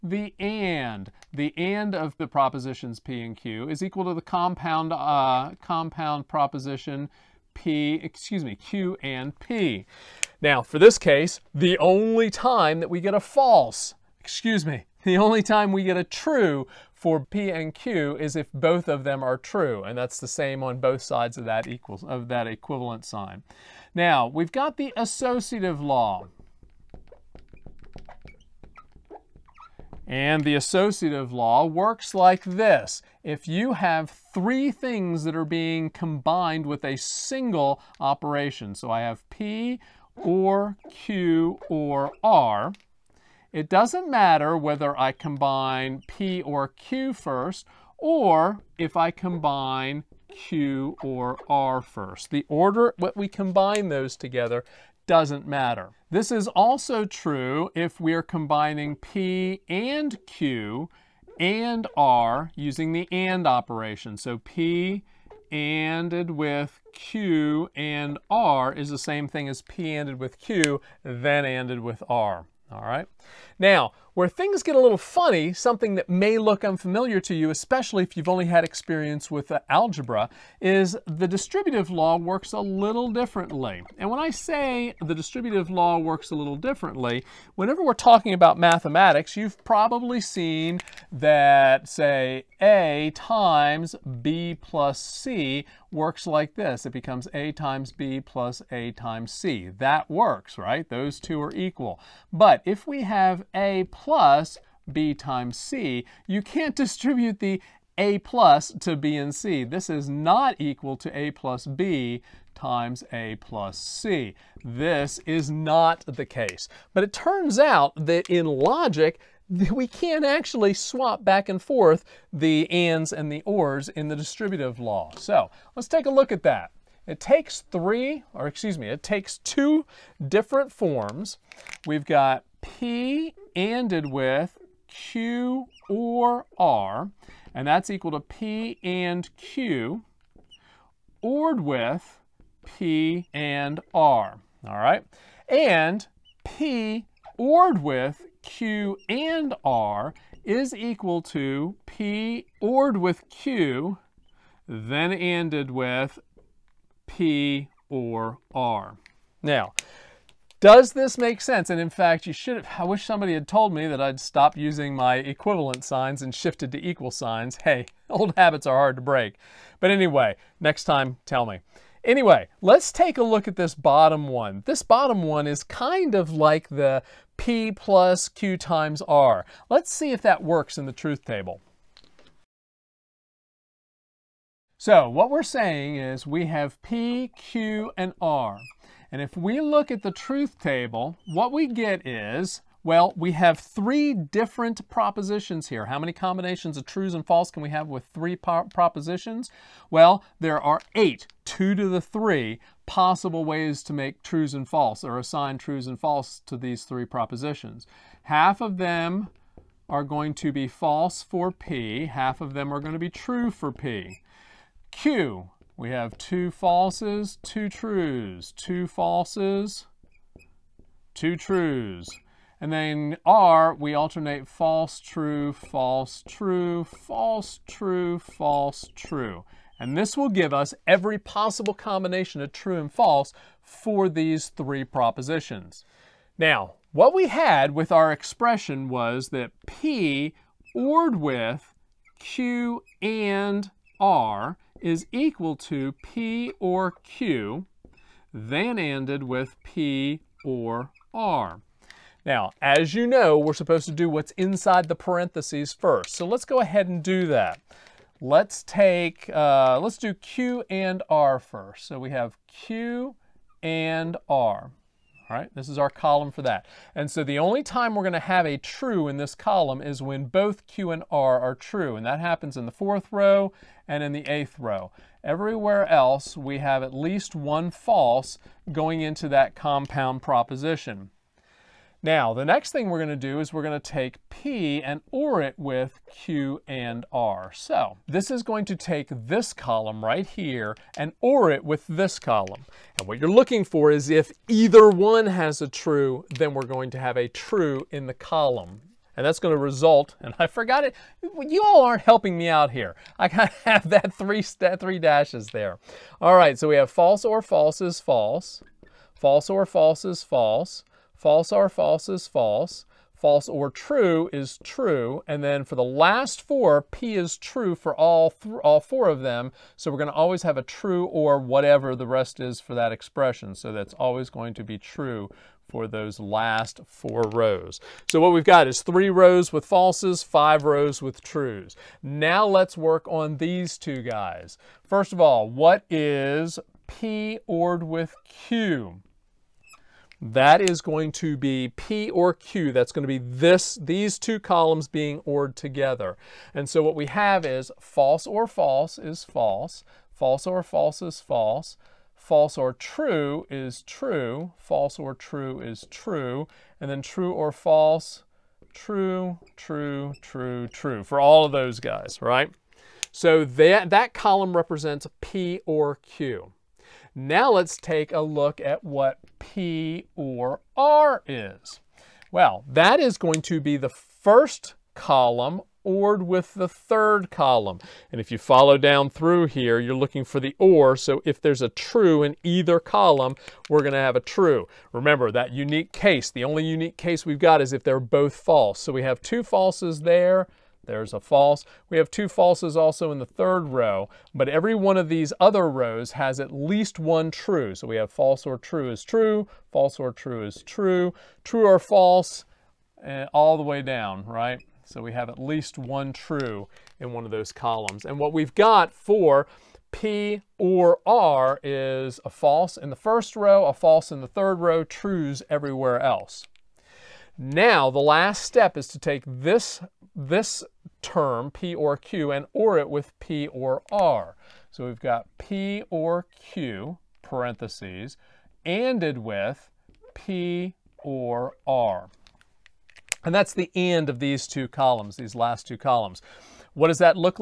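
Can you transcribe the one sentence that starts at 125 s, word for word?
So let's take a look at that.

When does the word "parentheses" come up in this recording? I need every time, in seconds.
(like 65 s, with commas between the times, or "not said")
254 s, 427 s.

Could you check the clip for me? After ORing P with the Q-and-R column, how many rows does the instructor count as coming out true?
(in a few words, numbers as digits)
5.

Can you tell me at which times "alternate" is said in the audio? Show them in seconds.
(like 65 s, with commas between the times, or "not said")
223 s.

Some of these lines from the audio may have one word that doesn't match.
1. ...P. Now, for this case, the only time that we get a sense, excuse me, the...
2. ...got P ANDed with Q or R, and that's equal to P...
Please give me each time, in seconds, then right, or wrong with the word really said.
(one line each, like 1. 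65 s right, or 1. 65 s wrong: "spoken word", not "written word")
1. 9 s wrong: "false", not "sense"
2. 132 s right.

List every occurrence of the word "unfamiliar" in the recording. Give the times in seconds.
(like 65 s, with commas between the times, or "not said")
76 s.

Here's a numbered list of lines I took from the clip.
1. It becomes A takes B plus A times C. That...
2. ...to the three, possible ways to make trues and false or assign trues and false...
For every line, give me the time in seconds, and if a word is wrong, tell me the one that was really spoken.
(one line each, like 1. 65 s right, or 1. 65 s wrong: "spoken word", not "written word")
1. 96 s wrong: "times", not "takes"
2. 201 s right.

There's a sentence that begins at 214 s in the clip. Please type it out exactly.
Q, we have two falses, two trues, two falses, two trues.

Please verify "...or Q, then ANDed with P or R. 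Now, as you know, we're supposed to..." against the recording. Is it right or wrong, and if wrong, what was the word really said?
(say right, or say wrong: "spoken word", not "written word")
right.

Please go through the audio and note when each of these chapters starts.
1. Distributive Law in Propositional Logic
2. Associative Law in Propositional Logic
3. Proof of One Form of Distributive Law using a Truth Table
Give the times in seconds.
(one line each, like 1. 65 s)
1. 72 s
2. 22 s
3. 172 s.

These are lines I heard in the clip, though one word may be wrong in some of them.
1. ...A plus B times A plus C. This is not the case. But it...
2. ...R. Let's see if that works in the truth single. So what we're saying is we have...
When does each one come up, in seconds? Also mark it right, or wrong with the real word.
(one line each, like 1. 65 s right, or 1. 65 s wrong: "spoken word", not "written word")
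1. 111 s right
2. 179 s wrong: "table", not "single".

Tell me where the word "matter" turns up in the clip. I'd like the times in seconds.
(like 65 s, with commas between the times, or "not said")
44 s, 55 s.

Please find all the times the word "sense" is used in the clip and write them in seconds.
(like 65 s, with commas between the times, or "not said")
161 s.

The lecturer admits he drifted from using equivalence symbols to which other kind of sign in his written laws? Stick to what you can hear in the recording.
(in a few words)
equal signs.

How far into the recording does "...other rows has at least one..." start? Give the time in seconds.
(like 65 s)
395 s.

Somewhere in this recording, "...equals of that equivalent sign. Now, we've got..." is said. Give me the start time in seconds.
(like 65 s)
21 s.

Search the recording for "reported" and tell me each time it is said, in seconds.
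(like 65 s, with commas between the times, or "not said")
not said.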